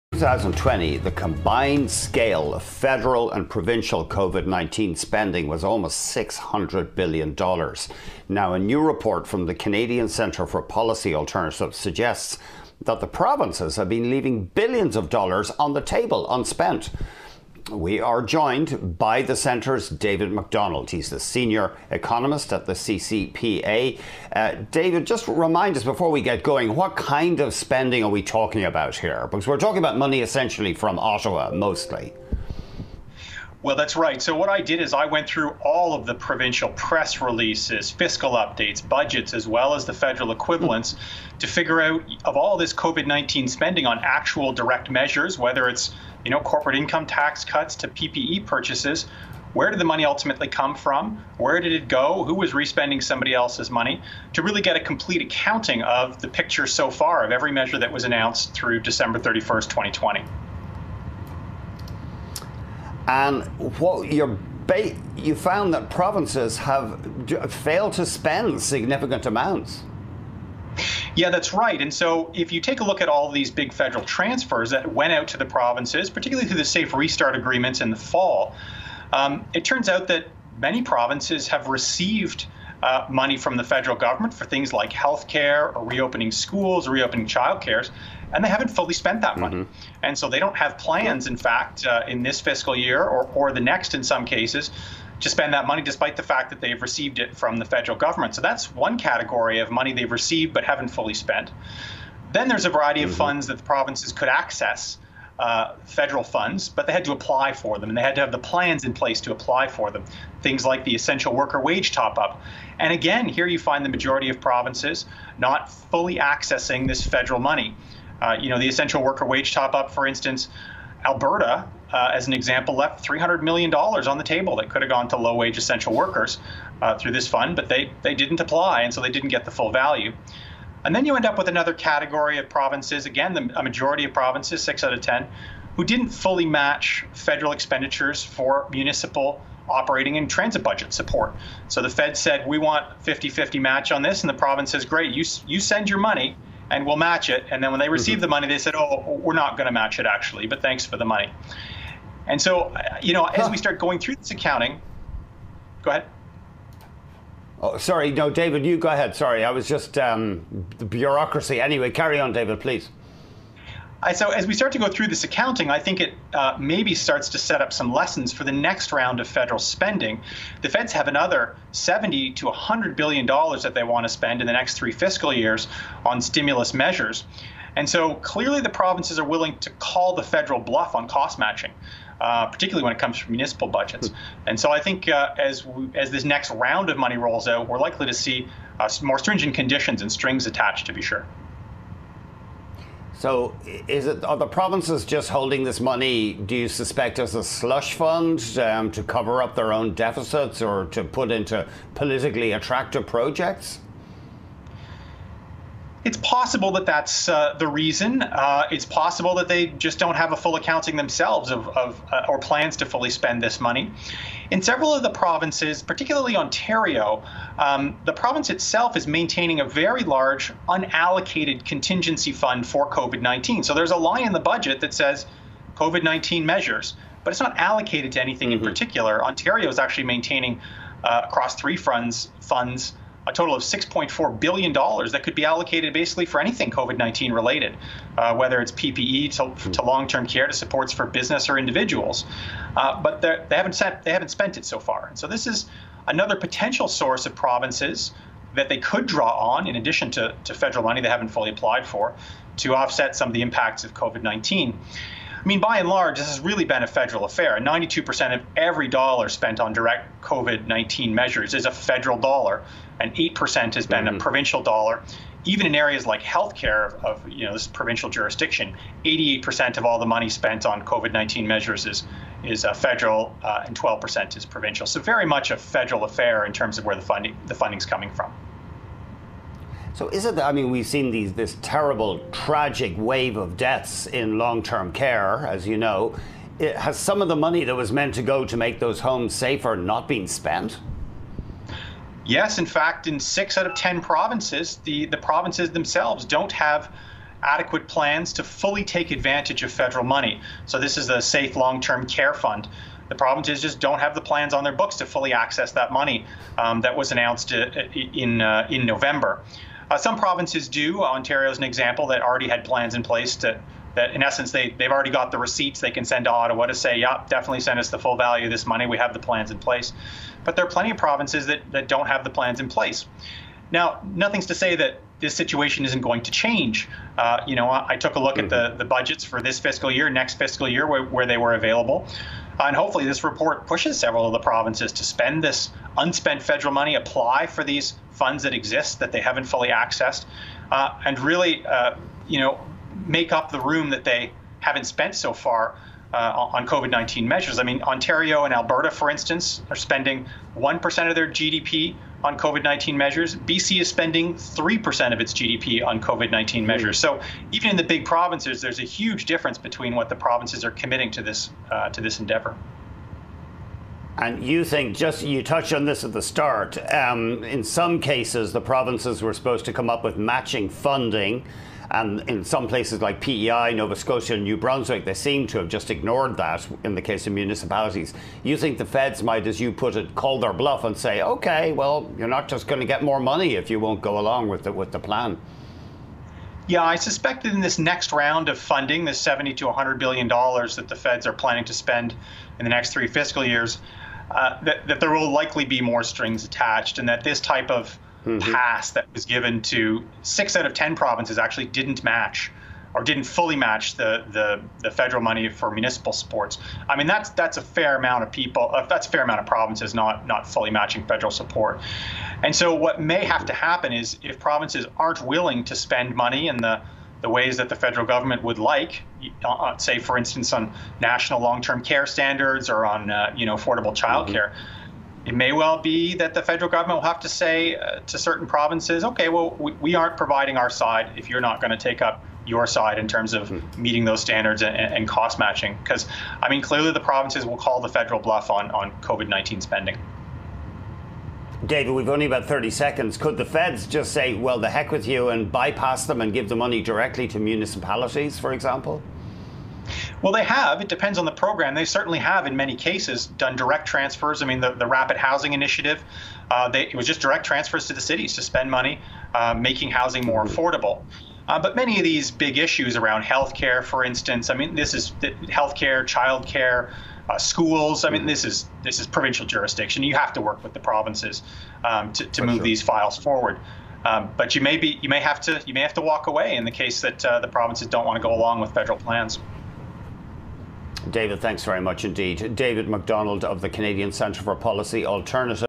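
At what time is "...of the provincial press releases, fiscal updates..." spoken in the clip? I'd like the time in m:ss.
0:35.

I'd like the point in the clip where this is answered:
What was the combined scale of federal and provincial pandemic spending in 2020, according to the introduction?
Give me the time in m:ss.
0:05.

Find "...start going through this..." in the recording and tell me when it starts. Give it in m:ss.
2:33.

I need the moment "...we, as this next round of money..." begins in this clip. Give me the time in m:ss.
3:05.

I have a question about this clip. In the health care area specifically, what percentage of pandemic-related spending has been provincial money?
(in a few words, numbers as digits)
12%.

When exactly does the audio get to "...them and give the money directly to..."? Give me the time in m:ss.
7:26.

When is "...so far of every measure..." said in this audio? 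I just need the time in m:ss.
0:56.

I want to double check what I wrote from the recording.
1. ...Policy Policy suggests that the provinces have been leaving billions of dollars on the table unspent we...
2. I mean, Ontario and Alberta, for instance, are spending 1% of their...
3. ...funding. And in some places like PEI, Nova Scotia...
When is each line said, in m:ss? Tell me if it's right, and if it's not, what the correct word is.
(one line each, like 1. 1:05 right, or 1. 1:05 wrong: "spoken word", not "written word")
1. 0:10 wrong: "Alternatives", not "Policy"
2. 5:47 right
3. 6:10 right.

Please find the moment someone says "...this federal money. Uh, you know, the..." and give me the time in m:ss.
1:56.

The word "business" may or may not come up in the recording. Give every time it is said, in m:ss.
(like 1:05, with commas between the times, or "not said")
4:01.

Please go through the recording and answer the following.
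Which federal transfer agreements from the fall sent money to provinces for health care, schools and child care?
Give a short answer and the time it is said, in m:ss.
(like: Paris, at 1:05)
Safe Restart agreements, at 1:16.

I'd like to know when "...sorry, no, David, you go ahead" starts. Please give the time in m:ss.
2:37.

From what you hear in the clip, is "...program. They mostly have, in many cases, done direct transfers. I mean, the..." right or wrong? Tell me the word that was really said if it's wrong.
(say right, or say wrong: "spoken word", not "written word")
wrong: "certainly", not "mostly".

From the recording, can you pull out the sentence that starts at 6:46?
I mean, that's that's a fair amount of people.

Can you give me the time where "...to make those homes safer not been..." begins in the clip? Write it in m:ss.
4:48.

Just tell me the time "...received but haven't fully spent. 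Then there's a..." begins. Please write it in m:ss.
1:40.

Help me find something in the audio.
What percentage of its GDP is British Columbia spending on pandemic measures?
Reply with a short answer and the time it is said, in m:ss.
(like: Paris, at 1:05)
3%, at 5:54.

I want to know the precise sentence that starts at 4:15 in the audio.
I mean, by and large, this has really been a federal affair.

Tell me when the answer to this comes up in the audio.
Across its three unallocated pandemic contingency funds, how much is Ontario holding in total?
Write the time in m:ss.
3:53.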